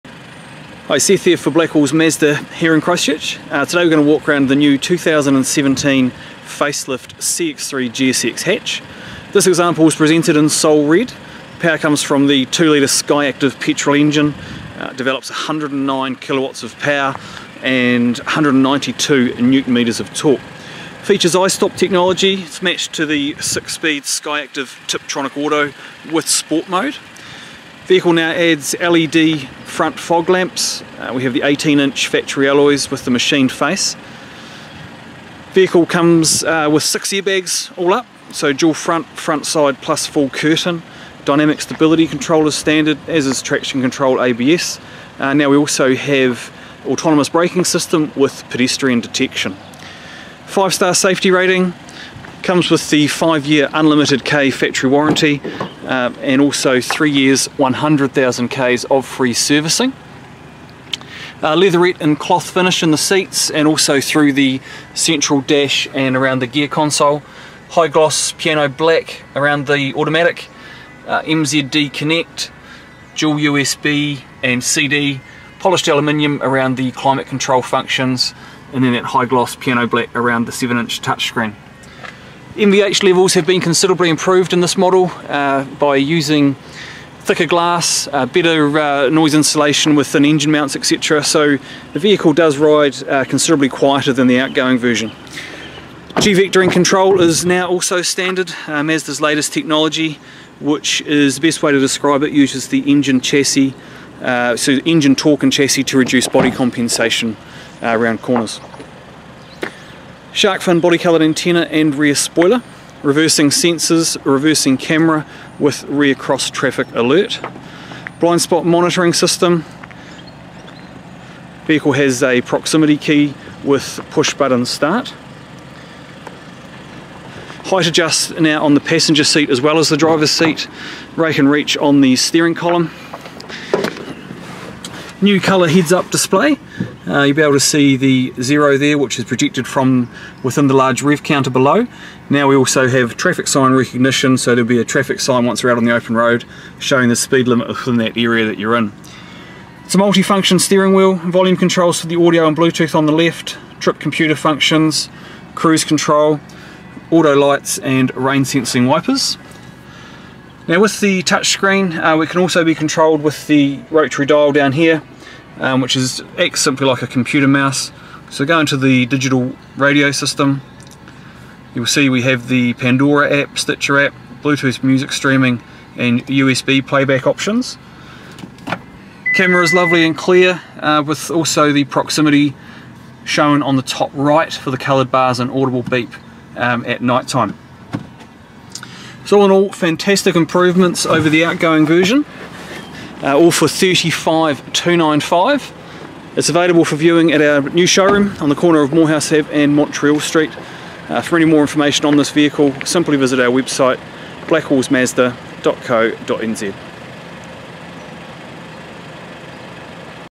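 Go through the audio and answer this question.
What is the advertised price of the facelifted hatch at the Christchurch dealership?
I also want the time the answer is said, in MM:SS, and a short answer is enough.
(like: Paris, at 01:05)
$35,295, at 03:13.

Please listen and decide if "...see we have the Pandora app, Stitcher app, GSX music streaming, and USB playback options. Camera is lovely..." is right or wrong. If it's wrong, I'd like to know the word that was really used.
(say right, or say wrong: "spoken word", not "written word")
wrong: "Bluetooth", not "GSX".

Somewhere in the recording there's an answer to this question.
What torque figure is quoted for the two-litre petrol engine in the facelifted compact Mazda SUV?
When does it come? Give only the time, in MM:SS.
00:18.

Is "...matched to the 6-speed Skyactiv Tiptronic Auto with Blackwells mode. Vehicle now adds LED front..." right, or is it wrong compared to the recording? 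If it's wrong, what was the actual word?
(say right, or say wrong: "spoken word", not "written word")
wrong: "Sport", not "Blackwells".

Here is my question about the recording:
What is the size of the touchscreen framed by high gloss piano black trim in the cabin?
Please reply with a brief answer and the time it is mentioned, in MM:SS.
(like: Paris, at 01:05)
7 inch, at 01:20.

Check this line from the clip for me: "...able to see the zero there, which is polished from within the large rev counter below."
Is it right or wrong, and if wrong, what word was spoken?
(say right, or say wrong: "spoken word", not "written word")
wrong: "projected", not "polished".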